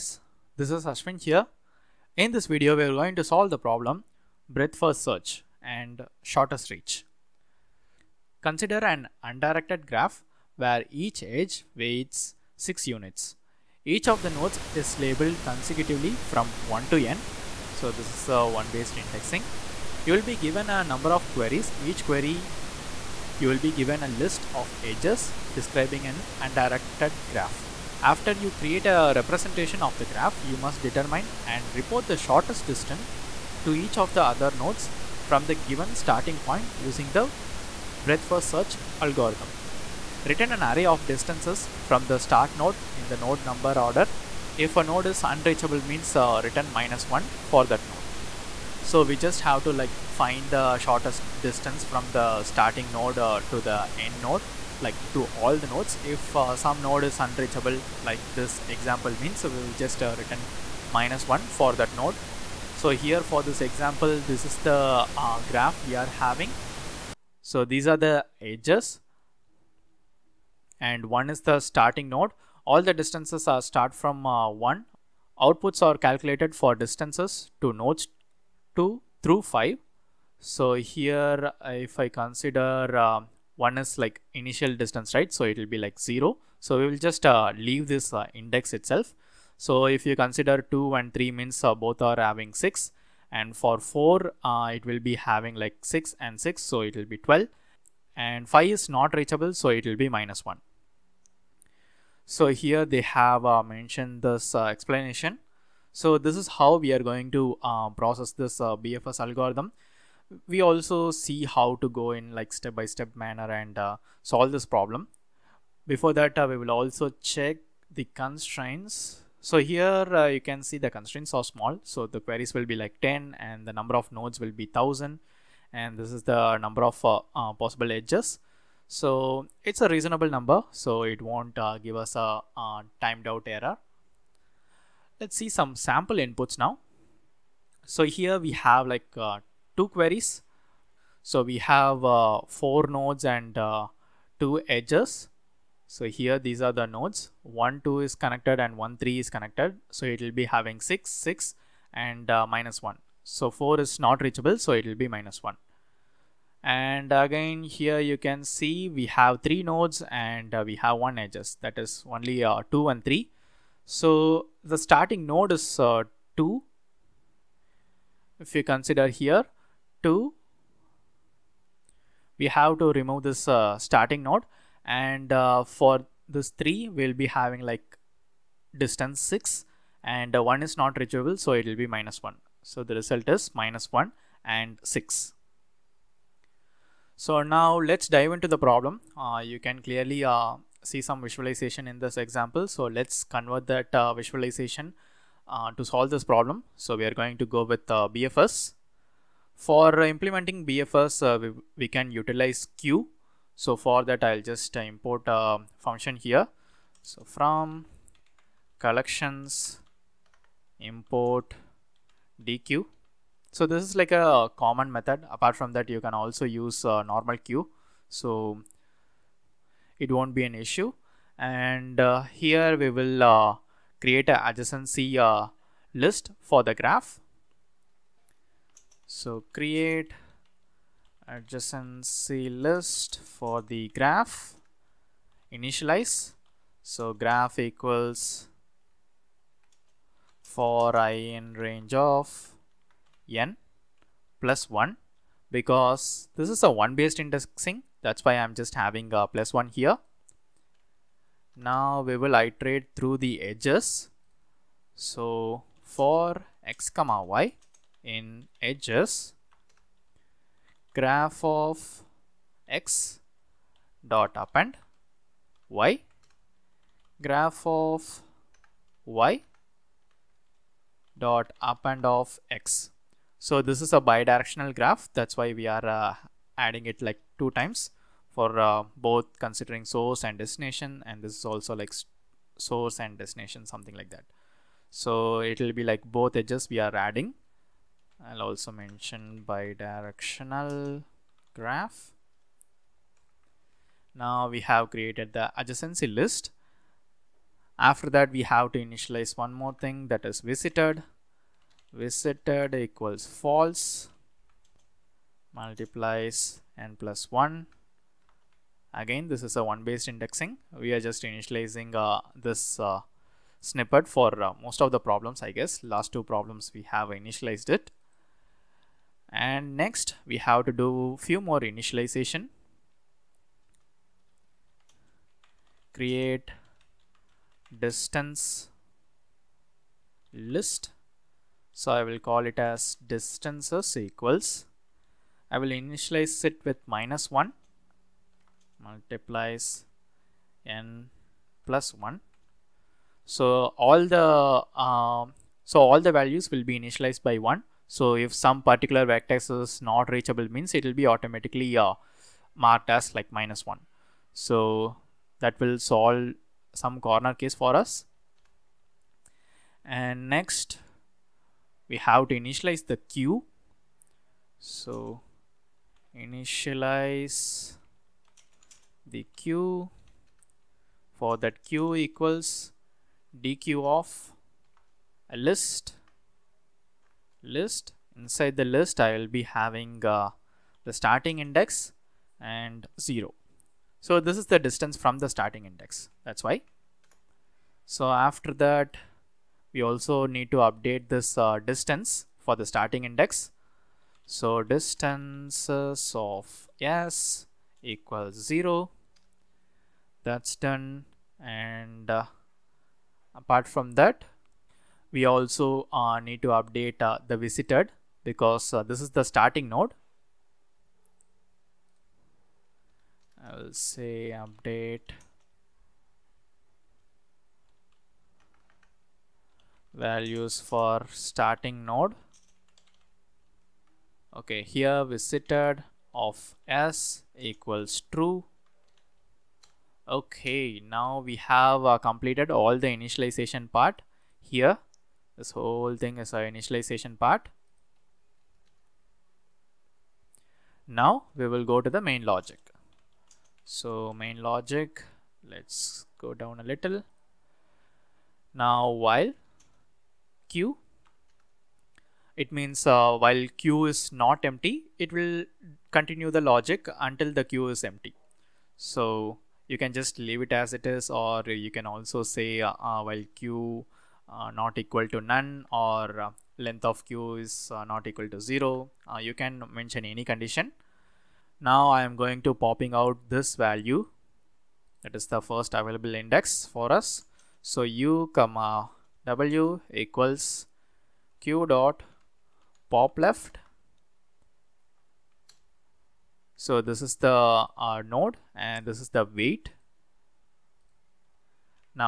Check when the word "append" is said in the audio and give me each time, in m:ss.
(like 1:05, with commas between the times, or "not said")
4:24, 4:31.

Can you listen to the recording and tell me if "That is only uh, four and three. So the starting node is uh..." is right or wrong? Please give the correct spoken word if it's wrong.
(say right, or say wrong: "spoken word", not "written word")
wrong: "two", not "four".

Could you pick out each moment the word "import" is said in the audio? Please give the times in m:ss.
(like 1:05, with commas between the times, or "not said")
3:24, 3:30.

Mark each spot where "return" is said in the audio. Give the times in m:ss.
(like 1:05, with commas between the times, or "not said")
0:40, 0:46, 1:00.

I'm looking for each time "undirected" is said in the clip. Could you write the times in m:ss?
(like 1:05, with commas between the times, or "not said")
0:09, 0:26.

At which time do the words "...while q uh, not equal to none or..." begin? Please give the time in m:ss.
7:43.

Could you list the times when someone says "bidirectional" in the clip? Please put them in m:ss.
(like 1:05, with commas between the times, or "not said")
4:34, 4:49.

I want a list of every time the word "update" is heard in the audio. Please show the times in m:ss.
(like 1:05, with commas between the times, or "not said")
6:30, 6:46, 6:54.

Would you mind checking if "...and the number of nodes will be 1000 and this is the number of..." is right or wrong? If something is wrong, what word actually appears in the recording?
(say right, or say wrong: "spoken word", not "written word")
right.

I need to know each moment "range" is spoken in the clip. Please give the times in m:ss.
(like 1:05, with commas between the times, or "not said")
4:01.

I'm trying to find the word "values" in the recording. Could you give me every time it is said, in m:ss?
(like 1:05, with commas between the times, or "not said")
5:46, 6:59, 7:53.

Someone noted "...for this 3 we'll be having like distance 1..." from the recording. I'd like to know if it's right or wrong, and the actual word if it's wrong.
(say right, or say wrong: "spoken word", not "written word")
wrong: "6", not "1".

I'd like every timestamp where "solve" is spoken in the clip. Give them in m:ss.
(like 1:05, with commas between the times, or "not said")
0:03, 1:54, 3:15, 5:55.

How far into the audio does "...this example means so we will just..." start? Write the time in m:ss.
0:58.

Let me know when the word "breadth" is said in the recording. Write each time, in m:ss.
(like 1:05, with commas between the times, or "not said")
0:04, 0:38.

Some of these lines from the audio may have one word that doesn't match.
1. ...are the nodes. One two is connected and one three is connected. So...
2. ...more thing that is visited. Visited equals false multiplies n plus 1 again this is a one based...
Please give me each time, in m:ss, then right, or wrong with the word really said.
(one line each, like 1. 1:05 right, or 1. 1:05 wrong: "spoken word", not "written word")
1. 2:26 right
2. 4:59 right.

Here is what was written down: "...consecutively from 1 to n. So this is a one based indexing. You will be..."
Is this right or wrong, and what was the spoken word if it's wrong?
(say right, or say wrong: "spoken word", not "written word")
right.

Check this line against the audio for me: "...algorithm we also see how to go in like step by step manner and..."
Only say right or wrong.
right.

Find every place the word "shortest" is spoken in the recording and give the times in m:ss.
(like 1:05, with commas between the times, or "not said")
0:06, 0:32, 0:50.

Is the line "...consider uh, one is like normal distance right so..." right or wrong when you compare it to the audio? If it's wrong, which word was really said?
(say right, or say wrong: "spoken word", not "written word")
wrong: "initial", not "normal".